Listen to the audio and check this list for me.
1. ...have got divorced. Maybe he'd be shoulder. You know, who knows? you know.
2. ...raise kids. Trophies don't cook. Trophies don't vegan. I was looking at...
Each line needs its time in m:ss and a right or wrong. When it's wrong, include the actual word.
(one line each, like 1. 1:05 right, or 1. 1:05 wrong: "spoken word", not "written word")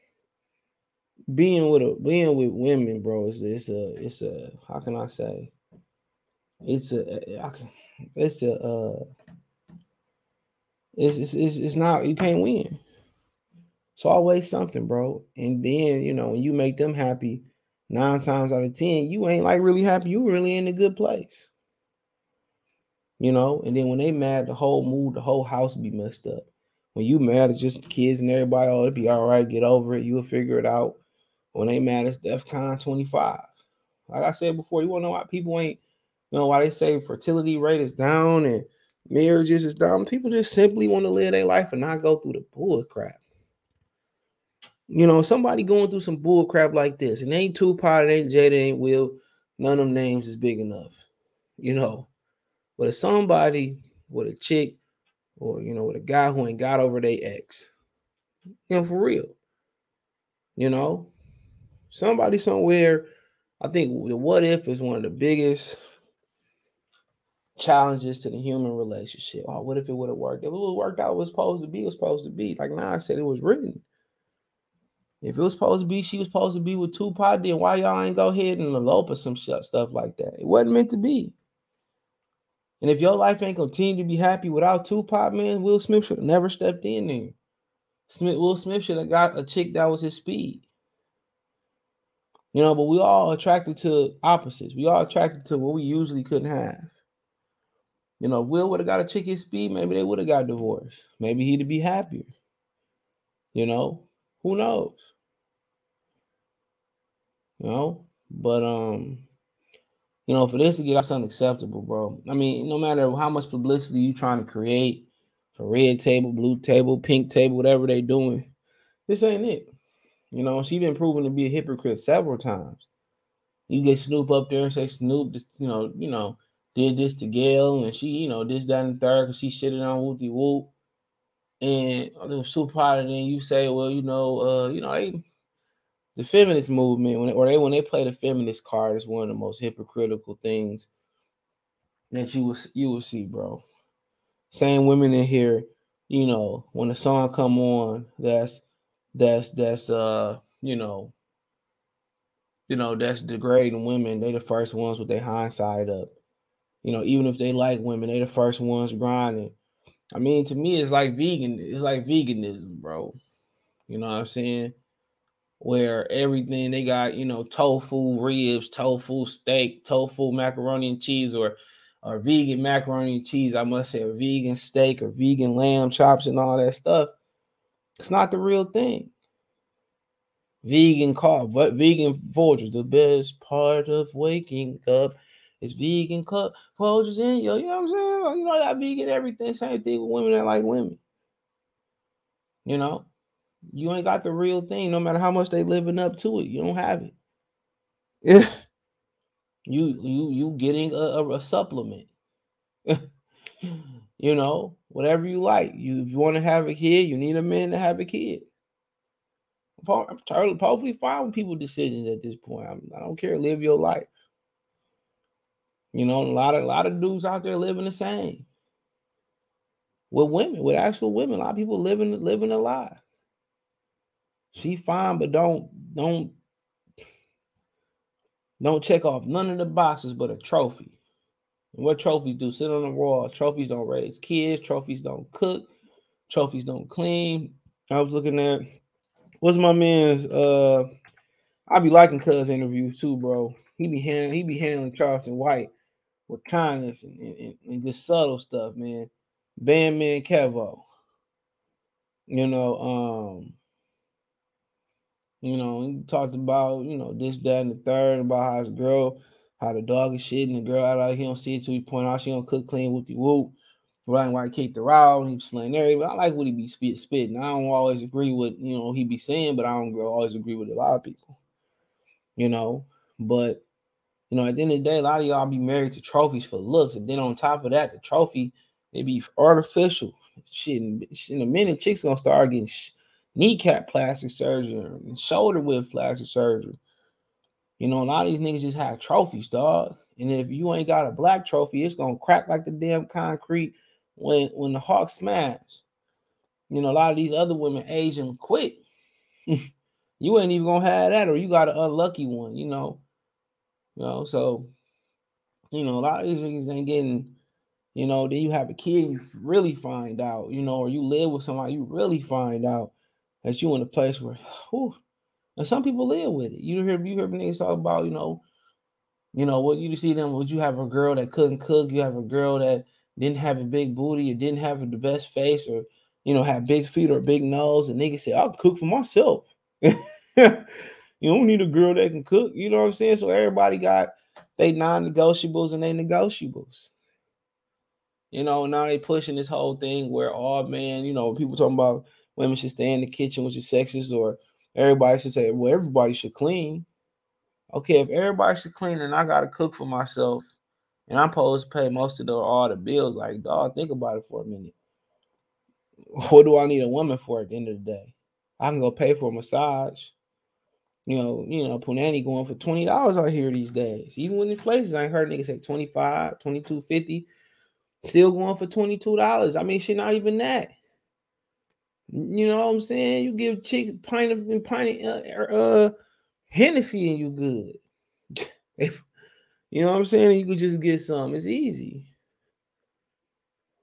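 1. 1:40 wrong: "happier", not "shoulder"
2. 3:53 wrong: "clean", not "vegan".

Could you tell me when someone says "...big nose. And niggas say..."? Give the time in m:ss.
5:27.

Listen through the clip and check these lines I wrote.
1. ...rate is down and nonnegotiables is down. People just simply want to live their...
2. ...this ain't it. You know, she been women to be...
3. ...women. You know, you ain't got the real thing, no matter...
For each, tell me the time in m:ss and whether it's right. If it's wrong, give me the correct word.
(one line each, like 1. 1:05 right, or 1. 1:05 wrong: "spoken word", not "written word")
1. 0:37 wrong: "marriages", not "nonnegotiables"
2. 1:59 wrong: "proven", not "women"
3. 3:10 right.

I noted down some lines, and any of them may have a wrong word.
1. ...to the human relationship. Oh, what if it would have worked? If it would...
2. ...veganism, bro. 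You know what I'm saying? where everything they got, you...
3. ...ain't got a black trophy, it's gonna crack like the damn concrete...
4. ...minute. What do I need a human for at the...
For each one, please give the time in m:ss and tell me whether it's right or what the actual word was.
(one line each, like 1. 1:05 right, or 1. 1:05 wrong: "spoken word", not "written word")
1. 1:08 right
2. 2:42 right
3. 4:50 right
4. 5:54 wrong: "woman", not "human".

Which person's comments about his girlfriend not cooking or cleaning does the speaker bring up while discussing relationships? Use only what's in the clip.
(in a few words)
Bandman Kevo.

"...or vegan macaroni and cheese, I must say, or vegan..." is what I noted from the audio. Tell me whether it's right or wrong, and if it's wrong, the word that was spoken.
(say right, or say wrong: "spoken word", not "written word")
right.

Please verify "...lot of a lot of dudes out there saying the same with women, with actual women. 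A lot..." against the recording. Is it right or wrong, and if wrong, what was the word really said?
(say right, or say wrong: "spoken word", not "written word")
wrong: "living", not "saying".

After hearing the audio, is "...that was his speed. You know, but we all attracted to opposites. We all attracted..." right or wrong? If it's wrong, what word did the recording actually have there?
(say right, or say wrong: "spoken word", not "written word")
right.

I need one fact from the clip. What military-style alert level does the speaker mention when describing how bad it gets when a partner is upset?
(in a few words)
DEFCON 25.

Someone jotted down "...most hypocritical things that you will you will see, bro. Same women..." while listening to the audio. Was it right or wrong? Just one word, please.
right.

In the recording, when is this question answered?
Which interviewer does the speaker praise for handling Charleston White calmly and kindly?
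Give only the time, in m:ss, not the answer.
4:02.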